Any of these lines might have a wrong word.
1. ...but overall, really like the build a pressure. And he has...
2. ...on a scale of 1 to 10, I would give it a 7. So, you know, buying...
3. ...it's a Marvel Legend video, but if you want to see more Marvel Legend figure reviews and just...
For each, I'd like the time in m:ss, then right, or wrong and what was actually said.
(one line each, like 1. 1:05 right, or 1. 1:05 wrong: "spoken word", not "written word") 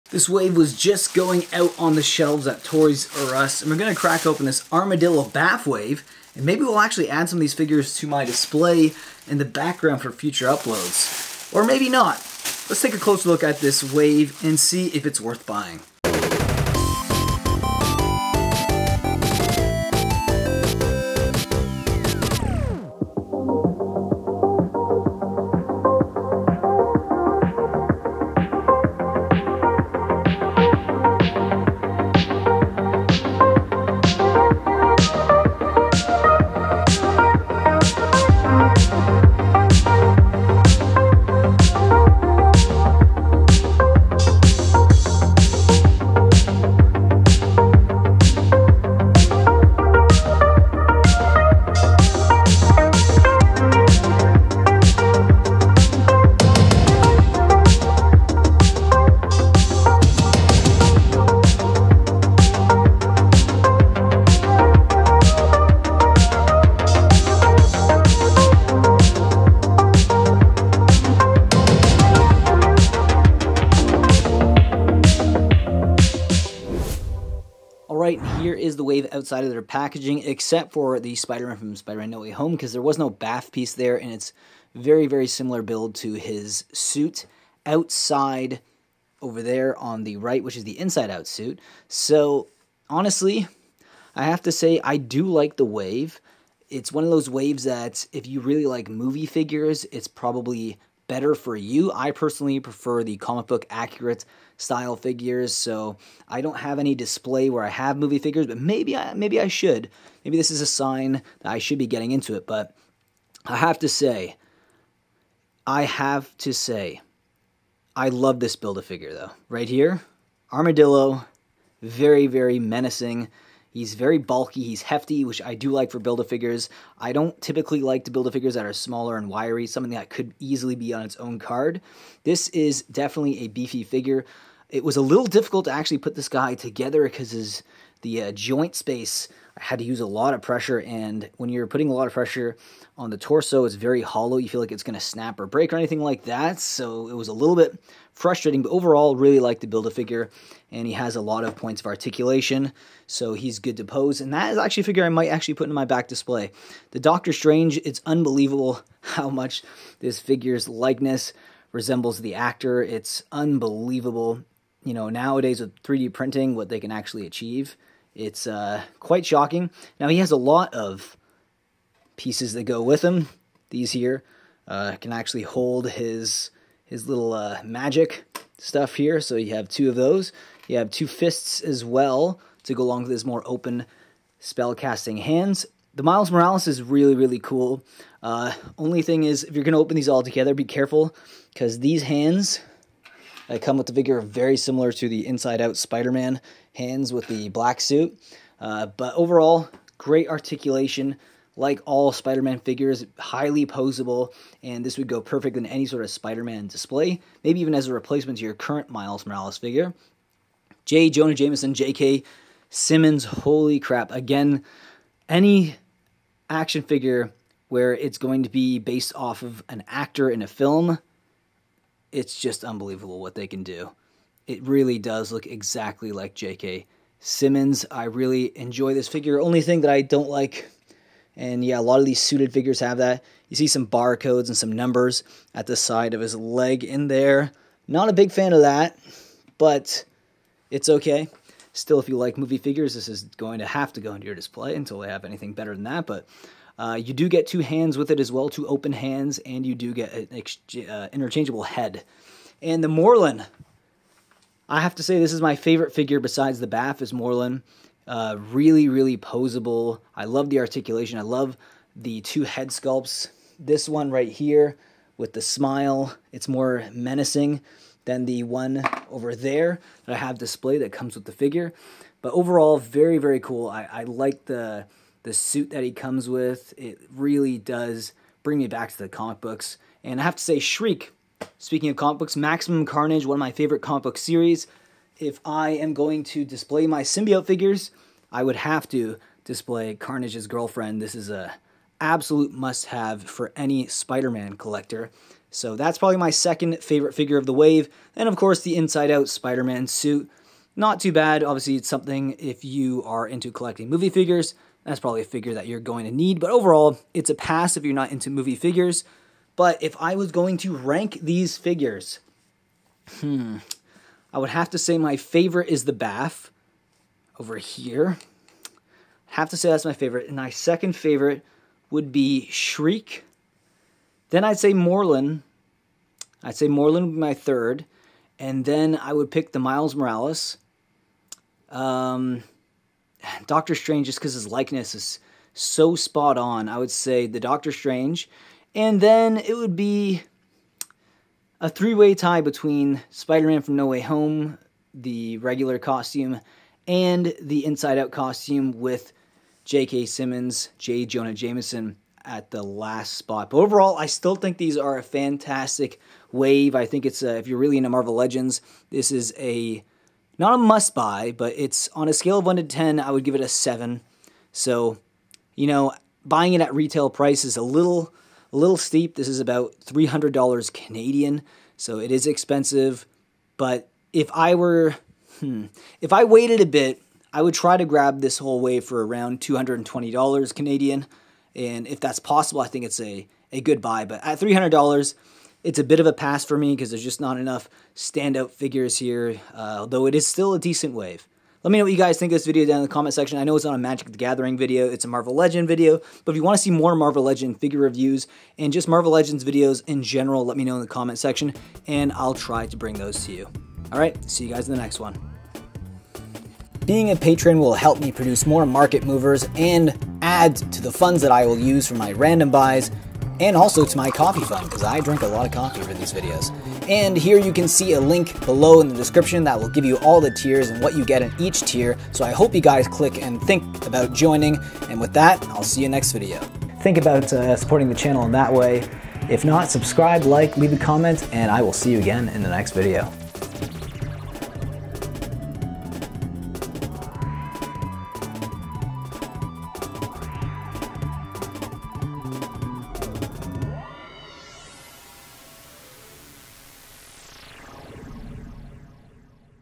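1. 2:28 wrong: "figure", not "pressure"
2. 6:01 right
3. 6:34 right.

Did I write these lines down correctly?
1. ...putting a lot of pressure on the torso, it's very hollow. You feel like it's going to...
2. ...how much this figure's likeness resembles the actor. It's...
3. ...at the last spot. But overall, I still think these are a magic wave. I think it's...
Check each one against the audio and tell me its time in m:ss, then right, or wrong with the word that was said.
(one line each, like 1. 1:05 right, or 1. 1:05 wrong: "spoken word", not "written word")
1. 2:21 right
2. 2:39 right
3. 5:52 wrong: "fantastic", not "magic".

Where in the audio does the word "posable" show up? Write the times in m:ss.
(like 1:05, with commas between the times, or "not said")
3:23, 4:19.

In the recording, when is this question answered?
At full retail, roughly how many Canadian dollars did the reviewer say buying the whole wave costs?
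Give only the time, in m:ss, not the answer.
6:09.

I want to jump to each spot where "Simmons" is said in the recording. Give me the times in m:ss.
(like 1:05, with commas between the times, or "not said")
3:32, 3:47, 5:50.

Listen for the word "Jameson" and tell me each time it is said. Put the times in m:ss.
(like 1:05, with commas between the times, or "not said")
3:31, 5:51.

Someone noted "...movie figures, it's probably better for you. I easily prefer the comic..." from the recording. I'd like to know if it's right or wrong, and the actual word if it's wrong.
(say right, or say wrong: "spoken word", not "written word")
wrong: "personally", not "easily".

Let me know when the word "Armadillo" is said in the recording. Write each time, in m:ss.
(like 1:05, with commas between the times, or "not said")
0:04, 2:00.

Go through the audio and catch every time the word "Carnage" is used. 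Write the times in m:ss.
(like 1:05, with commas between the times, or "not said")
4:42, 4:49.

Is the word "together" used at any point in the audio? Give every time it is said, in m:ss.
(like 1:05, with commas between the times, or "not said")
2:16, 3:10.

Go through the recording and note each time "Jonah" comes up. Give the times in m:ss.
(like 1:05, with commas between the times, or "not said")
3:31, 5:51.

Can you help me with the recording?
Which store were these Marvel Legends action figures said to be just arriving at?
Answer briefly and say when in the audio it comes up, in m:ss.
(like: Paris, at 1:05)
Toys R Us, at 0:02.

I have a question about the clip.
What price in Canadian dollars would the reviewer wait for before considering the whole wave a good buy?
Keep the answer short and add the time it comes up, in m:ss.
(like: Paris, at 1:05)
$220, at 6:19.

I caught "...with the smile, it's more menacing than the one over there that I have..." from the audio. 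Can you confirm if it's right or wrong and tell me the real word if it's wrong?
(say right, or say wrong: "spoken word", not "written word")
right.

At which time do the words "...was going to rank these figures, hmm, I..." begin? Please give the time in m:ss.
5:10.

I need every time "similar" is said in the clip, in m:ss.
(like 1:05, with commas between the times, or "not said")
1:25, 3:14.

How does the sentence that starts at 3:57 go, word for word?
Not a big fan of that, but it's okay.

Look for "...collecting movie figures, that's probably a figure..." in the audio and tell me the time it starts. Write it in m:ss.
5:03.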